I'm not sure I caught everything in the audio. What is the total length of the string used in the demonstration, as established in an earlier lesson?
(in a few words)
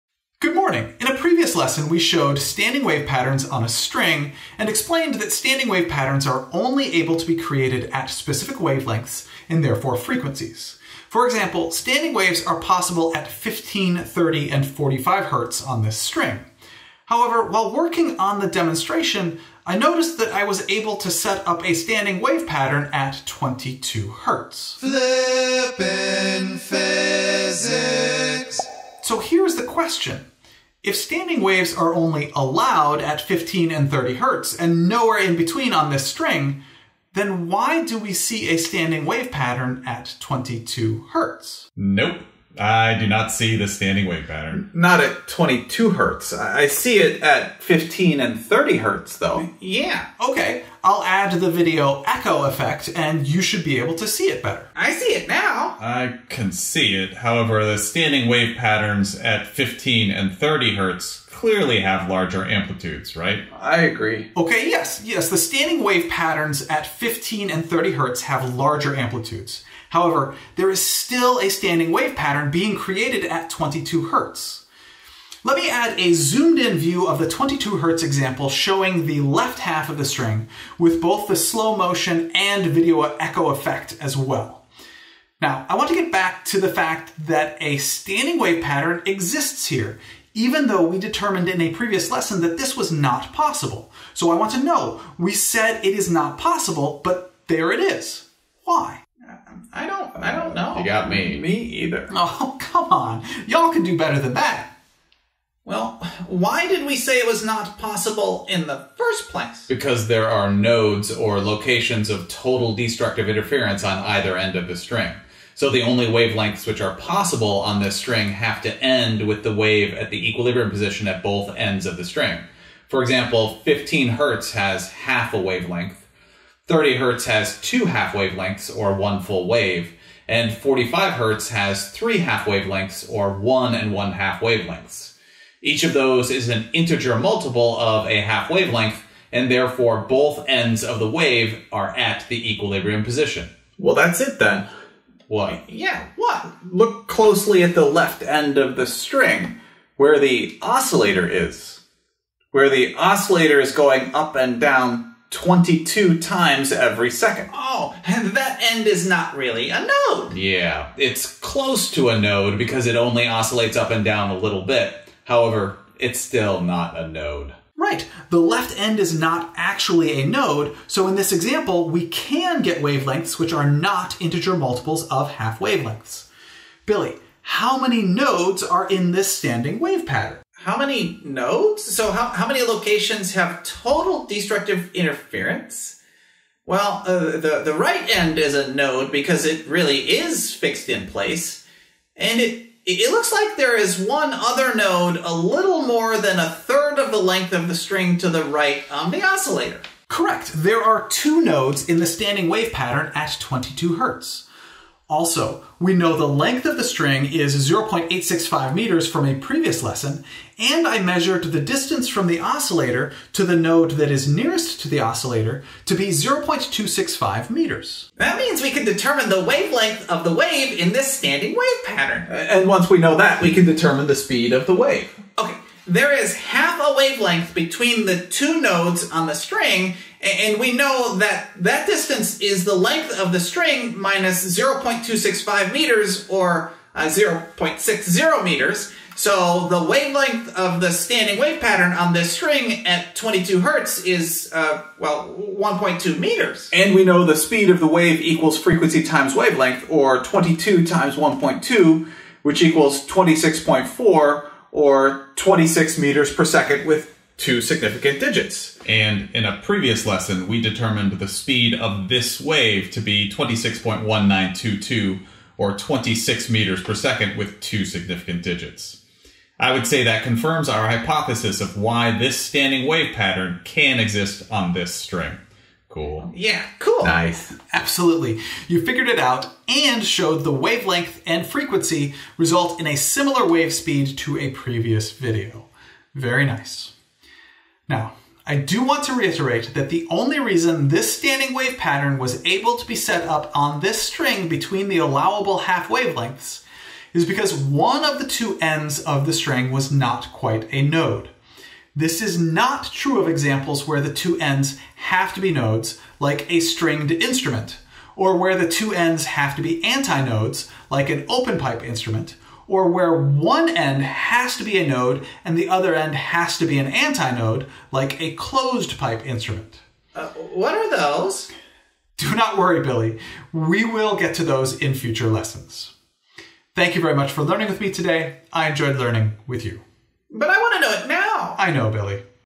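0.865 meters.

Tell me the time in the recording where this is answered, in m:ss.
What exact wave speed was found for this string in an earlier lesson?
4:23.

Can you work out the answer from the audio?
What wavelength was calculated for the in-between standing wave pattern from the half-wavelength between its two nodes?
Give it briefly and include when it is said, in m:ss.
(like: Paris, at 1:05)
1.2 meters, at 4:05.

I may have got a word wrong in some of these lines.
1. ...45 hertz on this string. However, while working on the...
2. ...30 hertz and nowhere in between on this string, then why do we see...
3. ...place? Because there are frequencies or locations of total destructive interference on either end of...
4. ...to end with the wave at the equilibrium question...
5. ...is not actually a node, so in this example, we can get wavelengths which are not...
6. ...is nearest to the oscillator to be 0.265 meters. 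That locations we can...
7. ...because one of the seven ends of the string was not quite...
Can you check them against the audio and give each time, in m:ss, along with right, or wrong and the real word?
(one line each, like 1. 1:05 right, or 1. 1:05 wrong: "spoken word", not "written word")
1. 0:14 right
2. 0:33 right
3. 1:49 wrong: "nodes", not "frequencies"
4. 1:58 wrong: "position", not "question"
5. 2:48 right
6. 3:34 wrong: "means", not "locations"
7. 4:57 wrong: "two", not "seven".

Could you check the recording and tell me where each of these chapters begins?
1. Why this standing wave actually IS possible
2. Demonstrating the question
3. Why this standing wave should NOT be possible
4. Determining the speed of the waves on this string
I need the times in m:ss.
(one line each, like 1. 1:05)
1. 2:26
2. 0:28
3. 1:44
4. 3:25.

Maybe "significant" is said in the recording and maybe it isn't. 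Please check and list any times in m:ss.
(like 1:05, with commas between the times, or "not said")
4:17, 4:27.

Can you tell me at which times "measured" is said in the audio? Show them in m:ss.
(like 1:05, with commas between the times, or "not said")
3:31.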